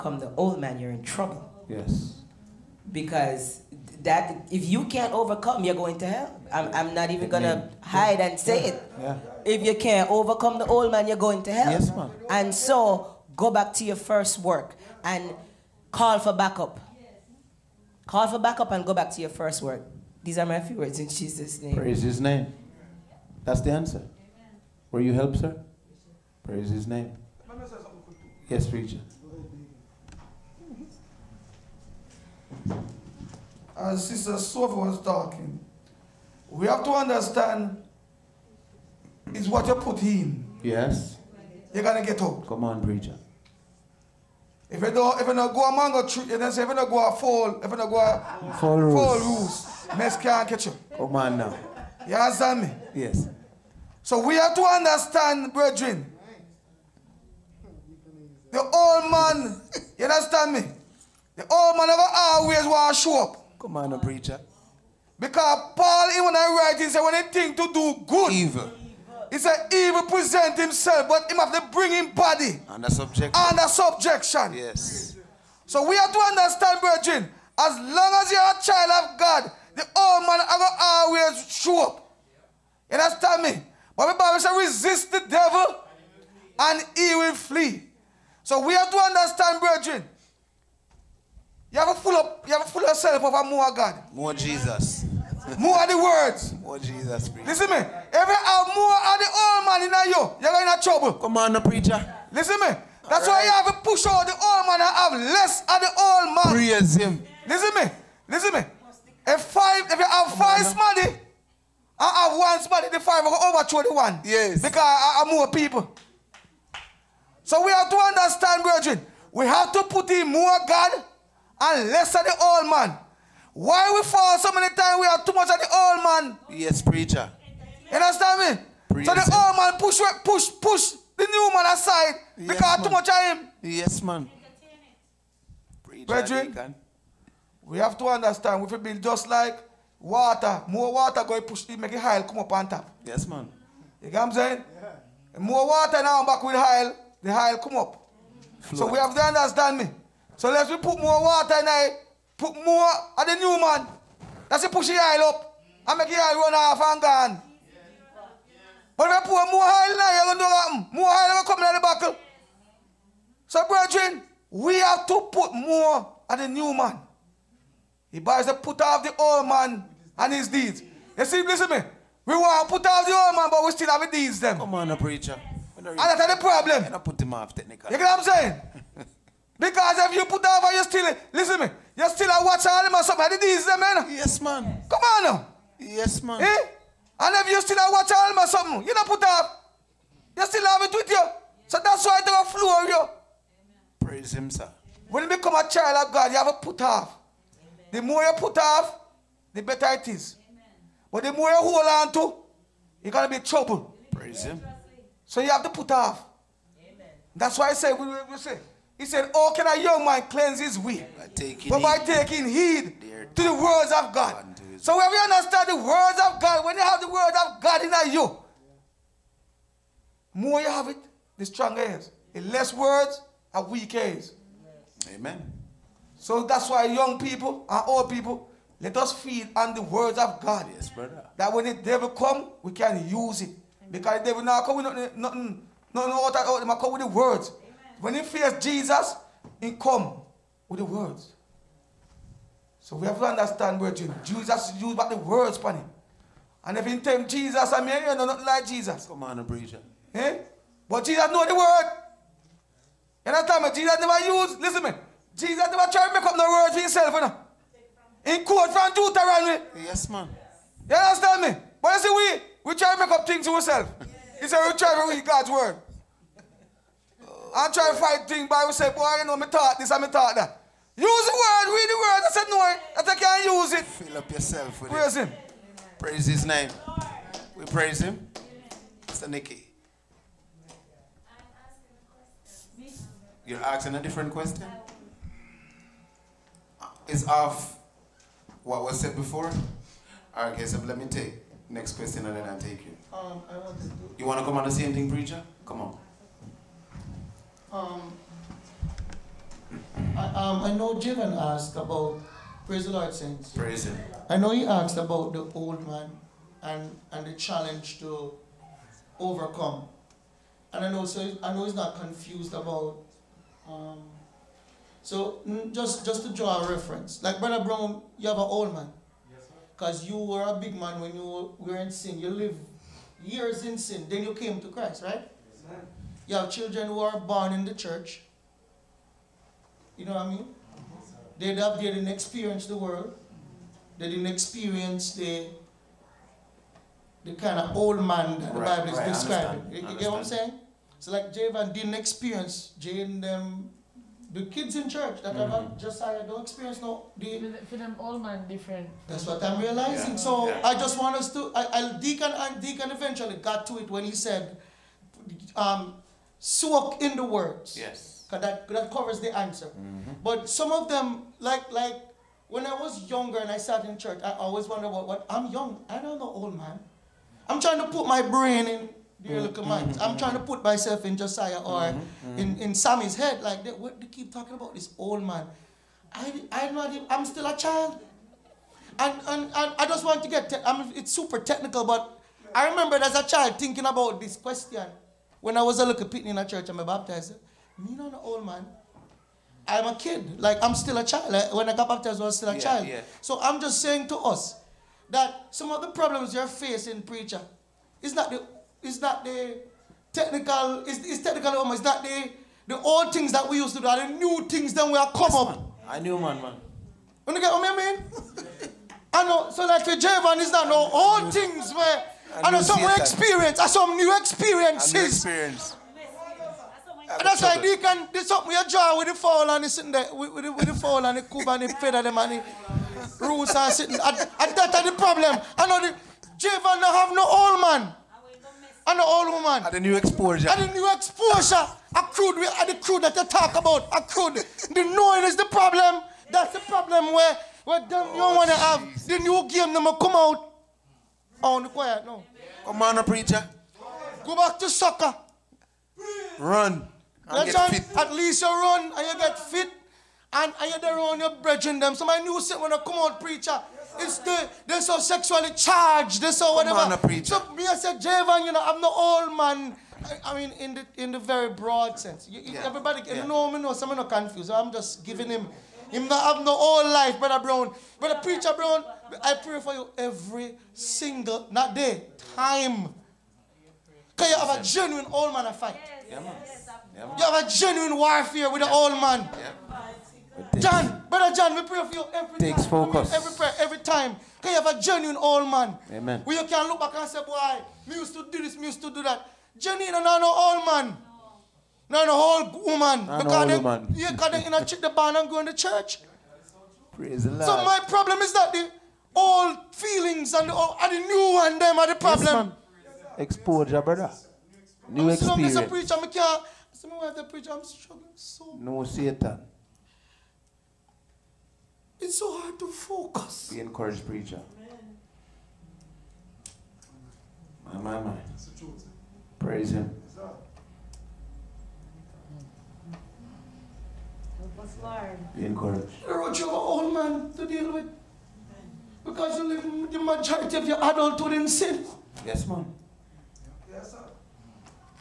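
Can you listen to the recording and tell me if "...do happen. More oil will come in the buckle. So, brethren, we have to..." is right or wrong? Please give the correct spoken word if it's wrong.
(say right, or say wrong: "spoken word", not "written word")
right.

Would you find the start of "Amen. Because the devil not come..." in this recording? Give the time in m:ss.
3:53.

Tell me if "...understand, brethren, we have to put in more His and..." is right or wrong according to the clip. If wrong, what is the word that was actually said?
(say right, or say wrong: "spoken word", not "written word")
wrong: "God", not "His".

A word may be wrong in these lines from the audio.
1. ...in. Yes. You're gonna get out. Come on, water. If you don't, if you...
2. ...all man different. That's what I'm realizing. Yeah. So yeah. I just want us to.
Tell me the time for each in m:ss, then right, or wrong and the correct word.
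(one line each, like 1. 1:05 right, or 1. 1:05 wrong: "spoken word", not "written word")
1. 0:40 wrong: "preacher", not "water"
2. 5:47 right.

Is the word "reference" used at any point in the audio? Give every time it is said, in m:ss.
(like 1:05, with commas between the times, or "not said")
5:16.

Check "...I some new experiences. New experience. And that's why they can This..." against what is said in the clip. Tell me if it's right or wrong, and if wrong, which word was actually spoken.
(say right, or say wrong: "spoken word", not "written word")
right.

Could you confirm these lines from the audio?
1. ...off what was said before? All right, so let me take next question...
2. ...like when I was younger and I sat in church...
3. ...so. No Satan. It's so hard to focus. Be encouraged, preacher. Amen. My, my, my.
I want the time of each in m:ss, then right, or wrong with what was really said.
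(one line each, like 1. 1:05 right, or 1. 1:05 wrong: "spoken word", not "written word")
1. 4:47 right
2. 6:01 right
3. 8:28 right.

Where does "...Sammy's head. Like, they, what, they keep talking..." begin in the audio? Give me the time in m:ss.
6:12.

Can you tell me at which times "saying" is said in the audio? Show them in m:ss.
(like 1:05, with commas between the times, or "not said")
2:24, 2:58, 5:40, 6:33.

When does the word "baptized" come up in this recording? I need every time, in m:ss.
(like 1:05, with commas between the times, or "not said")
6:26, 6:31.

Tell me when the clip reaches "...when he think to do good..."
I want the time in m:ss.
1:07.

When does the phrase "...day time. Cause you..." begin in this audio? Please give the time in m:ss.
7:51.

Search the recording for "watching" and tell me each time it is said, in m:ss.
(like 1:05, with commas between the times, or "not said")
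3:02, 3:07.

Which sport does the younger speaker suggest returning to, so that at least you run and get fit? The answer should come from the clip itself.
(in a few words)
Soccer.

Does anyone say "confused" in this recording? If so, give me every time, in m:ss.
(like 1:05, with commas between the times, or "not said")
5:11, 7:44.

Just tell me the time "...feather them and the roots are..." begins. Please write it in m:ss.
7:01.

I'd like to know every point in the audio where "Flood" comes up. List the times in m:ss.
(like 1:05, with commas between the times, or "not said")
2:28.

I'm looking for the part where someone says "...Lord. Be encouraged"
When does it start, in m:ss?
8:44.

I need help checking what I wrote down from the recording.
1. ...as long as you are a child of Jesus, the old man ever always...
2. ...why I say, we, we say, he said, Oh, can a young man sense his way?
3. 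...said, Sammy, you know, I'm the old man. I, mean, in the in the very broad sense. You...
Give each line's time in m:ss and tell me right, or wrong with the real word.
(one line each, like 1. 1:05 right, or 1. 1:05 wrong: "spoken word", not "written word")
1. 1:17 wrong: "God", not "Jesus"
2. 3:27 wrong: "cleanse", not "sense"
3. 7:37 wrong: "Javan", not "Sammy".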